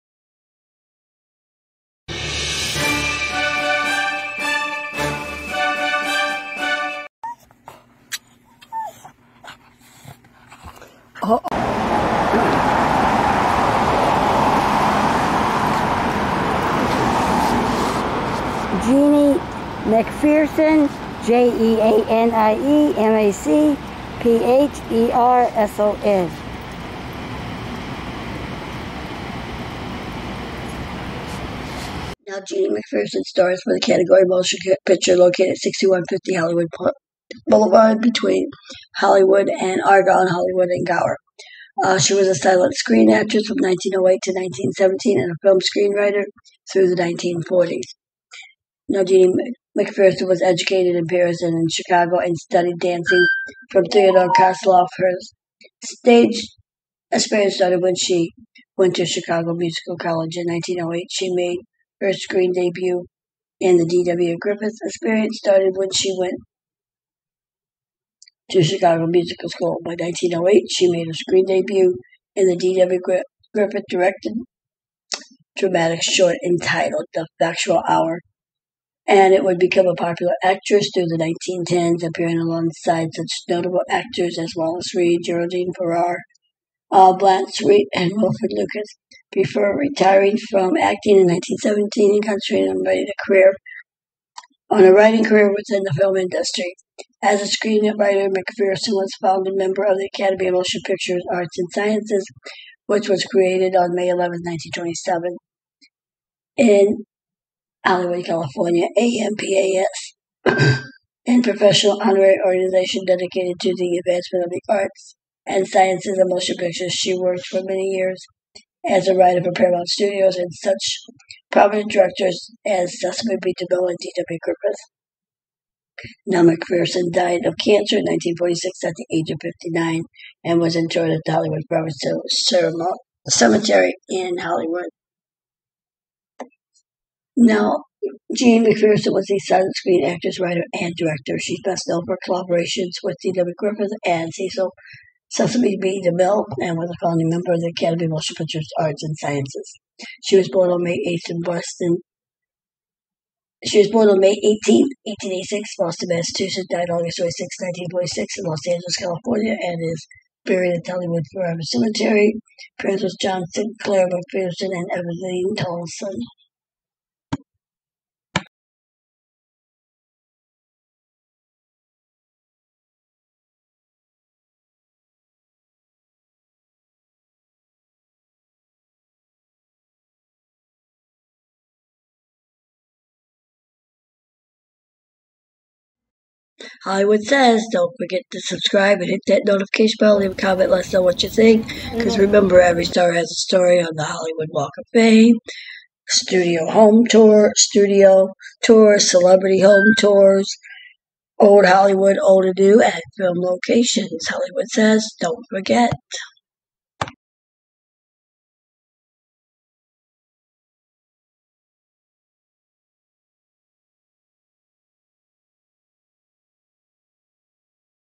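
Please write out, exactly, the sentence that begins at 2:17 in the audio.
Now, Jean MacPherson was a silent screen actress, writer, and director.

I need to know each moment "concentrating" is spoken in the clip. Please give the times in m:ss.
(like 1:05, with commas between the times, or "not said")
1:32.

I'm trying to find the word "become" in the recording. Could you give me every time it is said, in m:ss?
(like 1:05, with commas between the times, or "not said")
1:19.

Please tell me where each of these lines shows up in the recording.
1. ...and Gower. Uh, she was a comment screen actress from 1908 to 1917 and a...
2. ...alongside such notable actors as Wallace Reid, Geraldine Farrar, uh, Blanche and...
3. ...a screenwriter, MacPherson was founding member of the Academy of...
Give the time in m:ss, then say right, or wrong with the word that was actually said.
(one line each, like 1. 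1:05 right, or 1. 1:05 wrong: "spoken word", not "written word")
1. 0:40 wrong: "silent", not "comment"
2. 1:22 right
3. 1:37 right.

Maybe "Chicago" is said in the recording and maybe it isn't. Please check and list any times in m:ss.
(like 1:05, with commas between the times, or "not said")
0:51, 0:59, 1:08.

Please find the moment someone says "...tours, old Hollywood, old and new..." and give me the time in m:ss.
3:19.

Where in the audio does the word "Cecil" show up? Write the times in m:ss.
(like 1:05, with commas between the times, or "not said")
2:02, 2:24.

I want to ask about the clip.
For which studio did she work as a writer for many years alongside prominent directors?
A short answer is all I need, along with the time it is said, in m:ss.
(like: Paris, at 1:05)
Paramount Studios, at 1:59.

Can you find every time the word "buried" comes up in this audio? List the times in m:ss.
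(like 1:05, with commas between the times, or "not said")
2:40.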